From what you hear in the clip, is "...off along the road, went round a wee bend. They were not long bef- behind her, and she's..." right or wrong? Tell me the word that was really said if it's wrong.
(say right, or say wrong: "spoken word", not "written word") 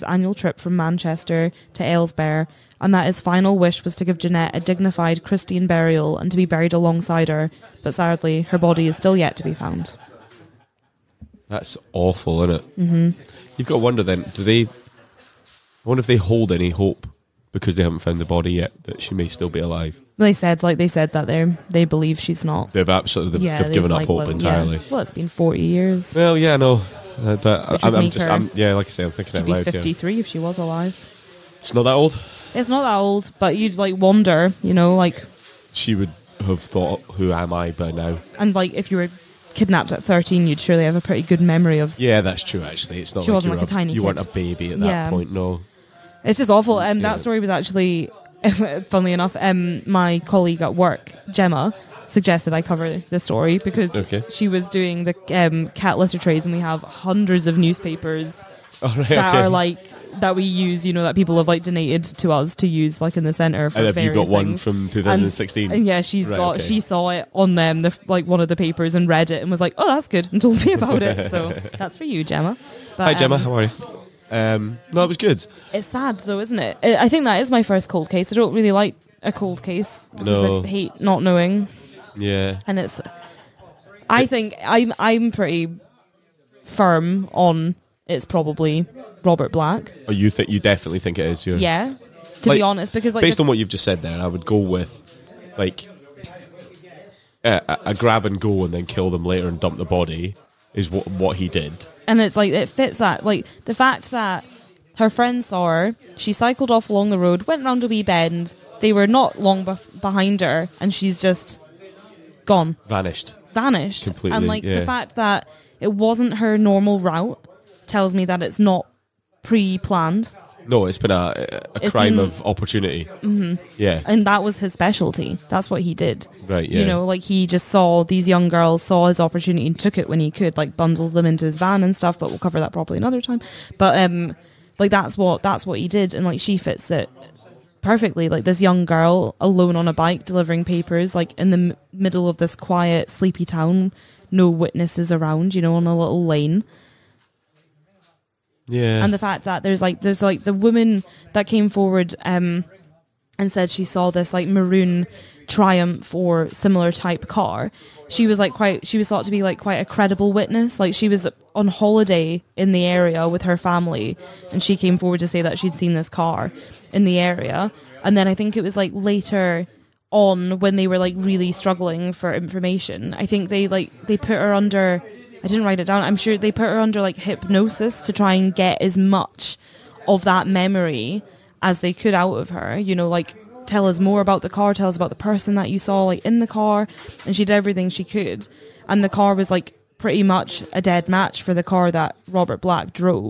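right.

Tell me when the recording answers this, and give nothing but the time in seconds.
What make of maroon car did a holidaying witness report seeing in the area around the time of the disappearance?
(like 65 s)
155 s.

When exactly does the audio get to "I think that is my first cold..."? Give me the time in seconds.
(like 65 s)
76 s.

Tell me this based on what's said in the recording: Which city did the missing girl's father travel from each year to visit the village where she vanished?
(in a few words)
Manchester.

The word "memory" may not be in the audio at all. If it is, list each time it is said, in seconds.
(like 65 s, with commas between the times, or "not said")
41 s, 180 s.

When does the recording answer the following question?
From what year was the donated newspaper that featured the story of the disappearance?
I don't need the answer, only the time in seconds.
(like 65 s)
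64 s.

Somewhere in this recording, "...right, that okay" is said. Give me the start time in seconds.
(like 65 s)
58 s.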